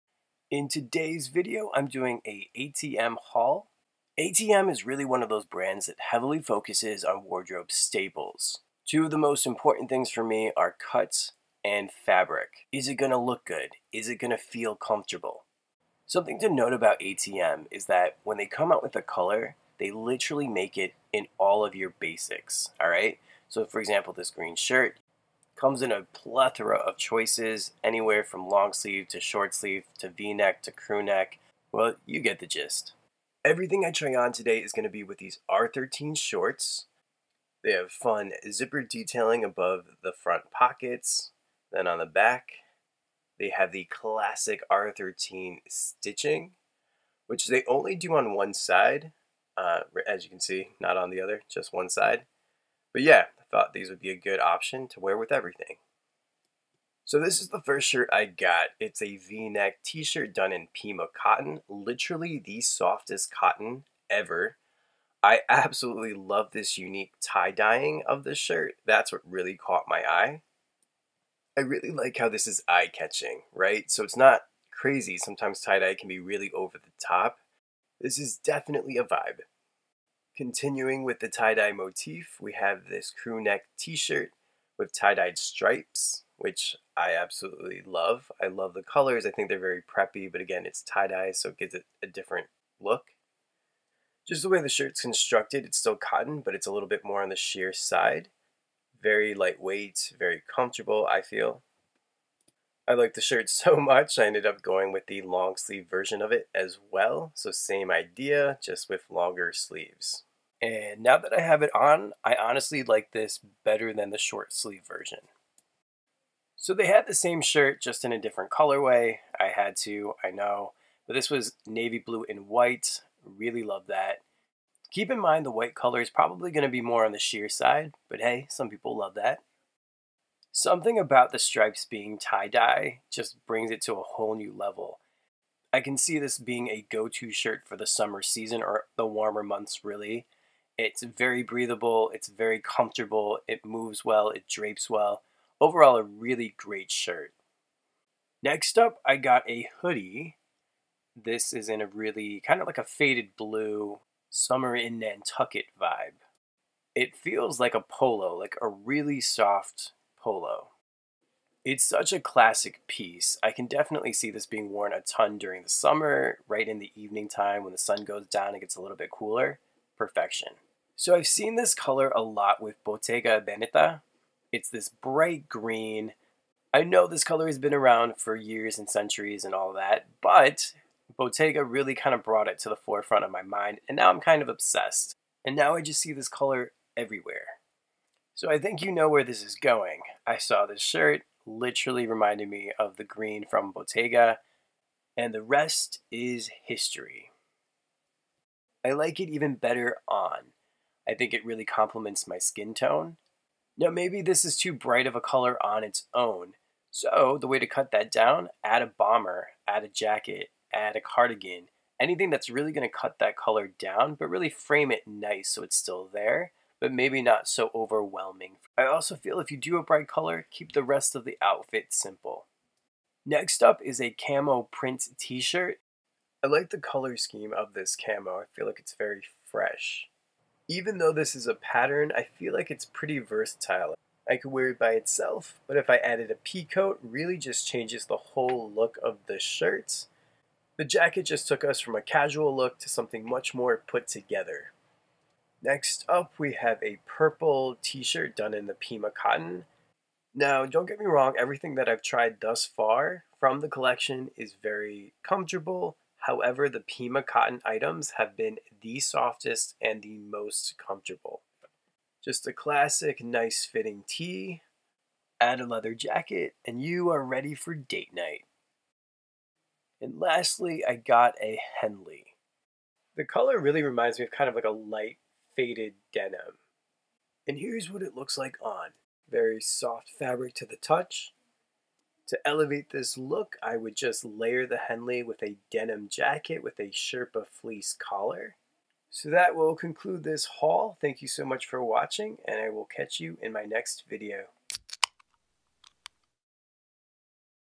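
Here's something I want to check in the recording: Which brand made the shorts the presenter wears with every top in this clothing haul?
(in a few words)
R13.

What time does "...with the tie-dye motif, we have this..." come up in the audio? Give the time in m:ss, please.
1:21.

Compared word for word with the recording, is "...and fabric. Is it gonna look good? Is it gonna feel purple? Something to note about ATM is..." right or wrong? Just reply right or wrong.
wrong.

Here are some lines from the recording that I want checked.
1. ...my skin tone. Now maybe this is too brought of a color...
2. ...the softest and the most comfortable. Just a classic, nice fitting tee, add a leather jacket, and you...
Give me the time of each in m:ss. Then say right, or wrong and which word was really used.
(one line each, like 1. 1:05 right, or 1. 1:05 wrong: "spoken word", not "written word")
1. 3:22 wrong: "bright", not "brought"
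2. 4:18 right.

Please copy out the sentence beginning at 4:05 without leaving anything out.
Next up, we have a purple t-shirt done in the Pima cotton.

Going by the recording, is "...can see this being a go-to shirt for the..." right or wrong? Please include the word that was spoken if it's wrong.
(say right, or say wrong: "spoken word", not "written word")
right.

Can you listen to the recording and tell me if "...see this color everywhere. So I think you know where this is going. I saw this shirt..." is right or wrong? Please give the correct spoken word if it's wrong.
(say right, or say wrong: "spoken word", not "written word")
right.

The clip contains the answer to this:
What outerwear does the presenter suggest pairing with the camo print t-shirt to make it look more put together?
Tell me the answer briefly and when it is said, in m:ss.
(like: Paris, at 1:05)
A pea coat, at 3:56.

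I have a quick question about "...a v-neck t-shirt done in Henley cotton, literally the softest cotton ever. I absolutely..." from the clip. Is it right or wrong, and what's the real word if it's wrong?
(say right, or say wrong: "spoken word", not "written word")
wrong: "Pima", not "Henley".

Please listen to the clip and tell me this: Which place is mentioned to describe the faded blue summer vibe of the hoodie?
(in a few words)
Nantucket.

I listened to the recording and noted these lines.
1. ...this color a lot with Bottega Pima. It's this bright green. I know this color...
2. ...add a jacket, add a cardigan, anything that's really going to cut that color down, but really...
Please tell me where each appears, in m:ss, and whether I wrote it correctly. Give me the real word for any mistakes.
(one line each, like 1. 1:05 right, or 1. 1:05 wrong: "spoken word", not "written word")
1. 2:51 wrong: "Veneta", not "Pima"
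2. 3:29 right.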